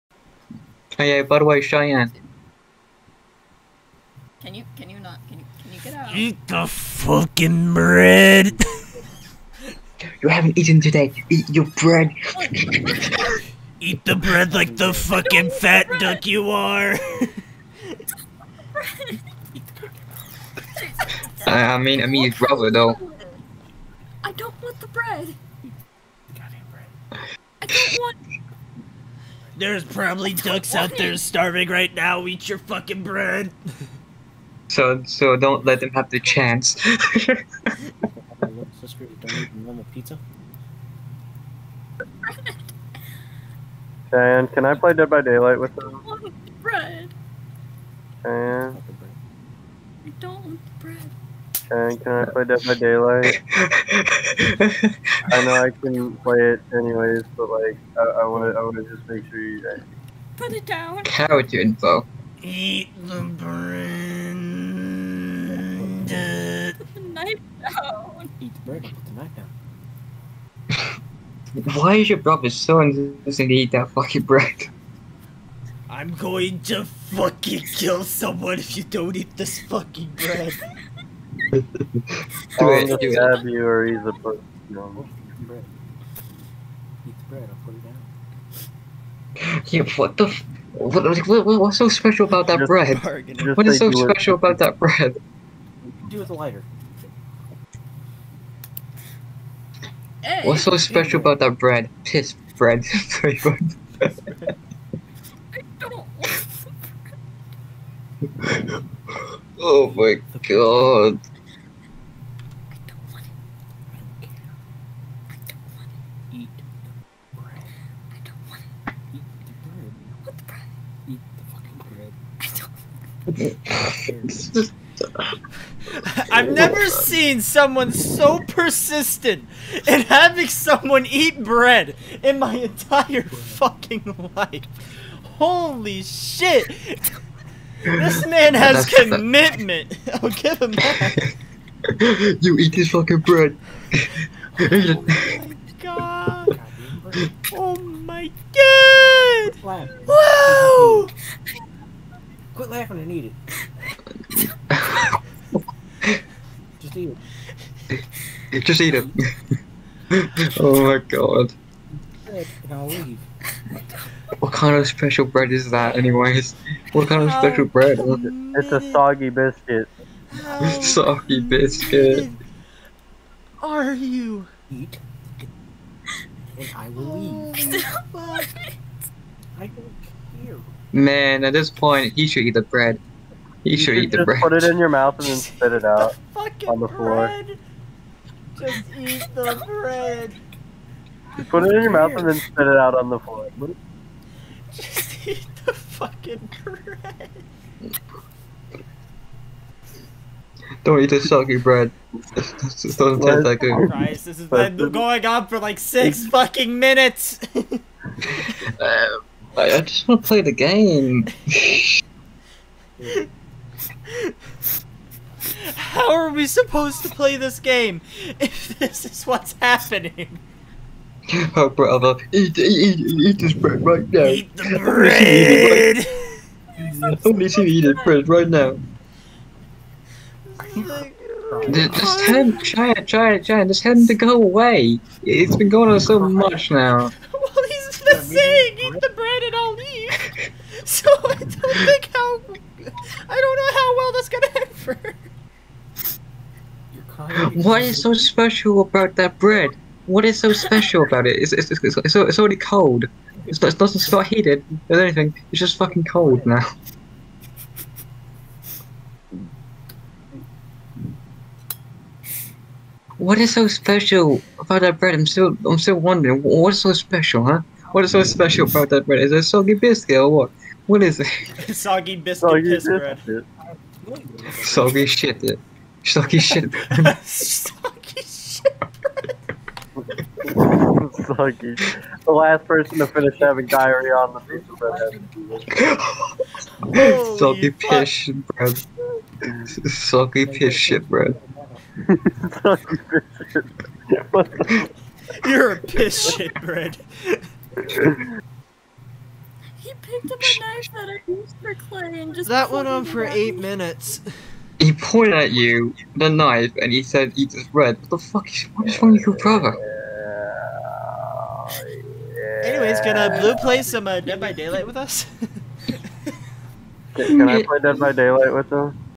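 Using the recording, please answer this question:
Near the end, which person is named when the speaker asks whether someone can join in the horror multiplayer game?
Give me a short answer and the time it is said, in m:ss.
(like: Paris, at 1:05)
Blue, at 5:13.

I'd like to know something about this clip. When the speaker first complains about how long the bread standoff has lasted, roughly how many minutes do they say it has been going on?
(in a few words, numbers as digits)
6.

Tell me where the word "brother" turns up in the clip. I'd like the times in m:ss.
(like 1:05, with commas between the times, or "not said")
1:12, 3:41, 5:09.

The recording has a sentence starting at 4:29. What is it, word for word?
Is it soggy biscuit or what?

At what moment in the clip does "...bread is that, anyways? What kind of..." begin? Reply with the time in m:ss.
2:45.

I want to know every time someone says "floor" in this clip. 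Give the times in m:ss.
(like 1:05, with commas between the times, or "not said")
3:06, 3:13.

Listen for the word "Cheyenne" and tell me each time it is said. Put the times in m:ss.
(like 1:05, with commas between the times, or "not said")
0:36, 0:48.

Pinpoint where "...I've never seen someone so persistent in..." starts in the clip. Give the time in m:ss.
2:06.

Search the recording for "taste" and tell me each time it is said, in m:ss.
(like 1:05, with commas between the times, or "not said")
3:23.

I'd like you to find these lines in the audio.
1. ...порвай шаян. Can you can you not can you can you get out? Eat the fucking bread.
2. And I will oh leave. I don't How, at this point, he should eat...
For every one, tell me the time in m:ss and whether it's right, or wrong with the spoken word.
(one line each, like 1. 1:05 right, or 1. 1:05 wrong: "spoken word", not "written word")
1. 0:01 right
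2. 2:56 wrong: "Man", not "How".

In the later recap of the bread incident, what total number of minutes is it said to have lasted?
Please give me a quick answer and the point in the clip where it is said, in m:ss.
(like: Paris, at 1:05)
8, at 5:03.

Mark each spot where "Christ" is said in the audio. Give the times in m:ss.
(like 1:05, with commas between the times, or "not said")
3:23.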